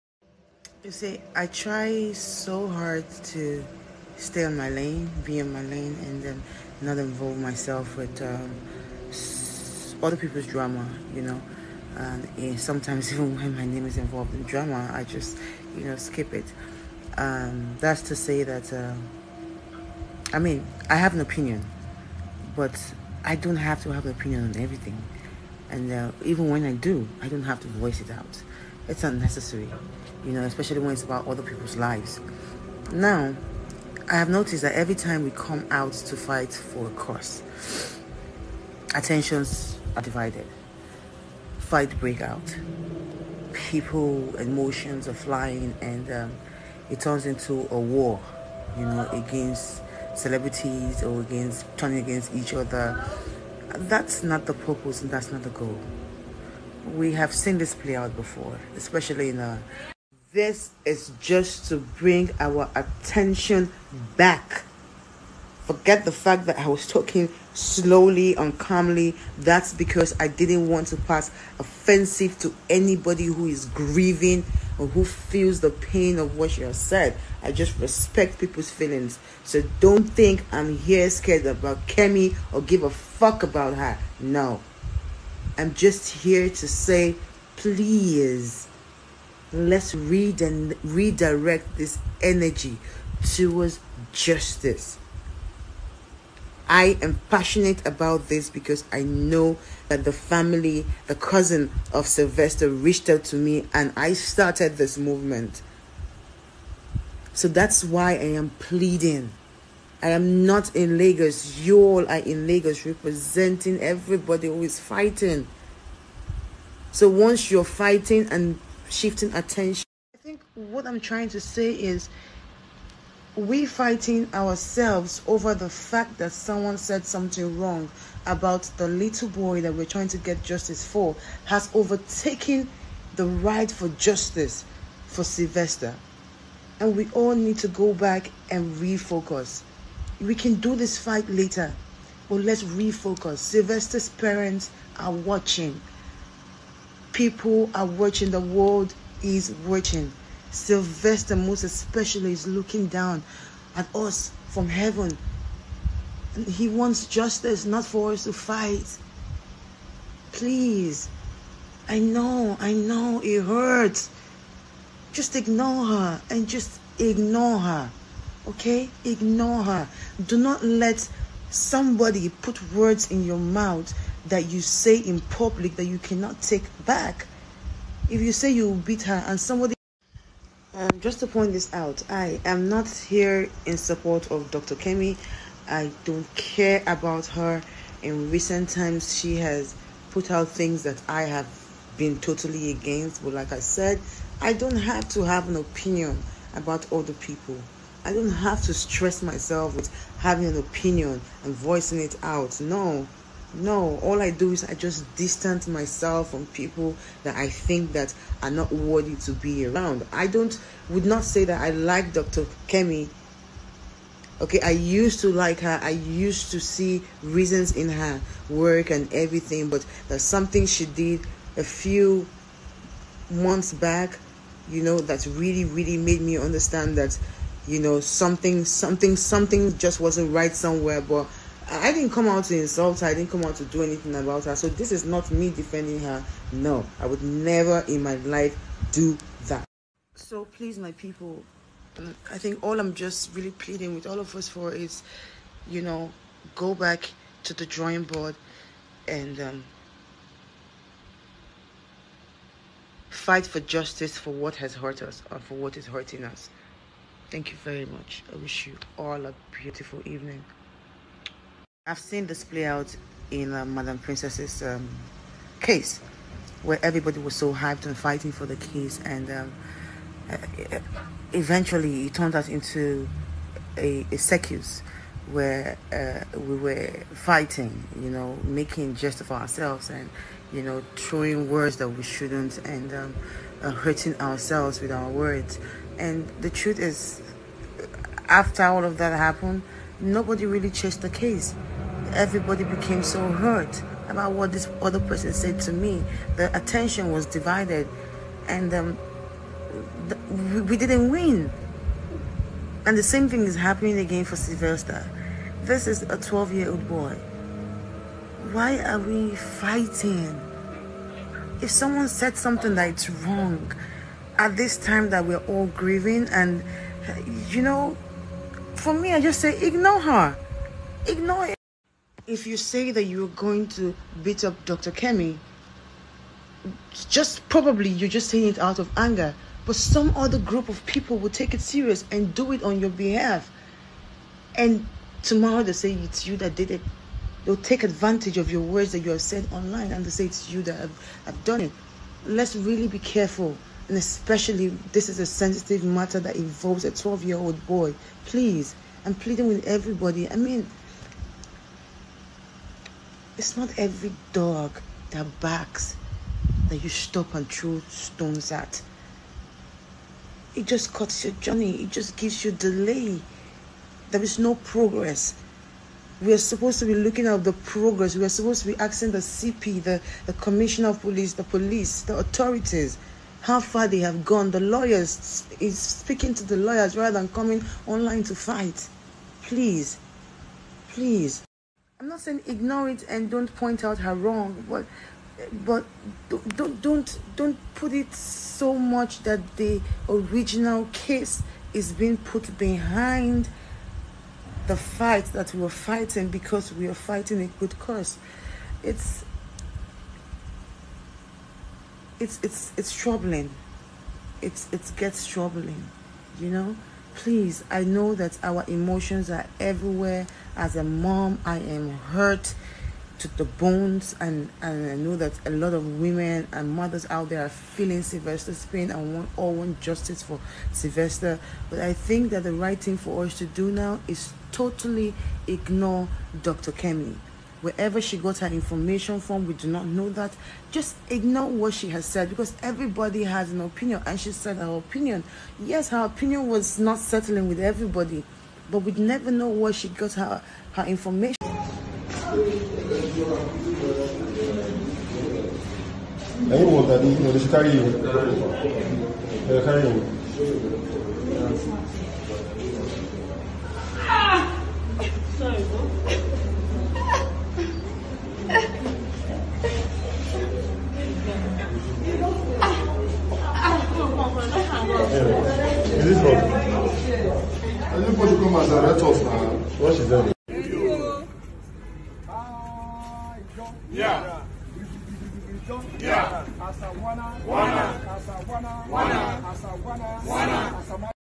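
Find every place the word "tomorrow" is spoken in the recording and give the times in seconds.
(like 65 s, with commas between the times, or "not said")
335 s.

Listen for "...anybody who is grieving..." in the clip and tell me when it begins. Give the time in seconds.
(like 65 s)
72 s.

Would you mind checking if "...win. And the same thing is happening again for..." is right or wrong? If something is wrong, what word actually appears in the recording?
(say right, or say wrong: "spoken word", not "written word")
right.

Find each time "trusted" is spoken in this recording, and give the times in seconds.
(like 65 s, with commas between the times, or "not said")
not said.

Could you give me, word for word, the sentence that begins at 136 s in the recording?
And we all need to go back and refocus we can do this fight later, but let's refocus.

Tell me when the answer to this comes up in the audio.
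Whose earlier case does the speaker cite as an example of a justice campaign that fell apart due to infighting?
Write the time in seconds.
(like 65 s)
264 s.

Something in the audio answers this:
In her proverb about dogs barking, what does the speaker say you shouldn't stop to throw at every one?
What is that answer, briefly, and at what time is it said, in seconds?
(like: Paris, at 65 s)
stones, at 357 s.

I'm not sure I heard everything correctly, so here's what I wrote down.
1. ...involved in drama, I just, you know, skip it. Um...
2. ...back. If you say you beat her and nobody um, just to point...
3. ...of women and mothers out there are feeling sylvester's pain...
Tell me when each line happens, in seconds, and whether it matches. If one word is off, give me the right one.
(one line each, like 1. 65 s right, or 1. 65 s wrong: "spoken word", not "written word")
1. 13 s right
2. 176 s wrong: "somebody", not "nobody"
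3. 415 s right.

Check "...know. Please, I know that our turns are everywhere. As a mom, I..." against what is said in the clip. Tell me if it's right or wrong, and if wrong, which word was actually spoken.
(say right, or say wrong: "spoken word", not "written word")
wrong: "emotions", not "turns".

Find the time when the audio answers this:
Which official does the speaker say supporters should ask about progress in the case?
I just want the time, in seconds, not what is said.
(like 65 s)
370 s.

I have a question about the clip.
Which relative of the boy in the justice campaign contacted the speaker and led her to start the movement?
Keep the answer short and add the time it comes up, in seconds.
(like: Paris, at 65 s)
cousin, at 101 s.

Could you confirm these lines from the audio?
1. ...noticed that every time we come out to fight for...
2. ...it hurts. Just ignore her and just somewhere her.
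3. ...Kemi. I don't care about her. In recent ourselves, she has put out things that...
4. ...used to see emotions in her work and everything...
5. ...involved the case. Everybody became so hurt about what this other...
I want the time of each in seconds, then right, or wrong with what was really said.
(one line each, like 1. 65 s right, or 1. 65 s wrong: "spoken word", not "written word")
1. 34 s right
2. 163 s wrong: "ignore", not "somewhere"
3. 184 s wrong: "times", not "ourselves"
4. 215 s wrong: "reasons", not "emotions"
5. 290 s wrong: "chased", not "involved".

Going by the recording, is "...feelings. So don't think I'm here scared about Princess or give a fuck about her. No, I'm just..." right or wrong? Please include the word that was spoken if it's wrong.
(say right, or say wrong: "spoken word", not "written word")
wrong: "Kemi", not "Princess".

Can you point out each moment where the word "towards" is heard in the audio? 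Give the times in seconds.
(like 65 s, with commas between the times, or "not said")
93 s.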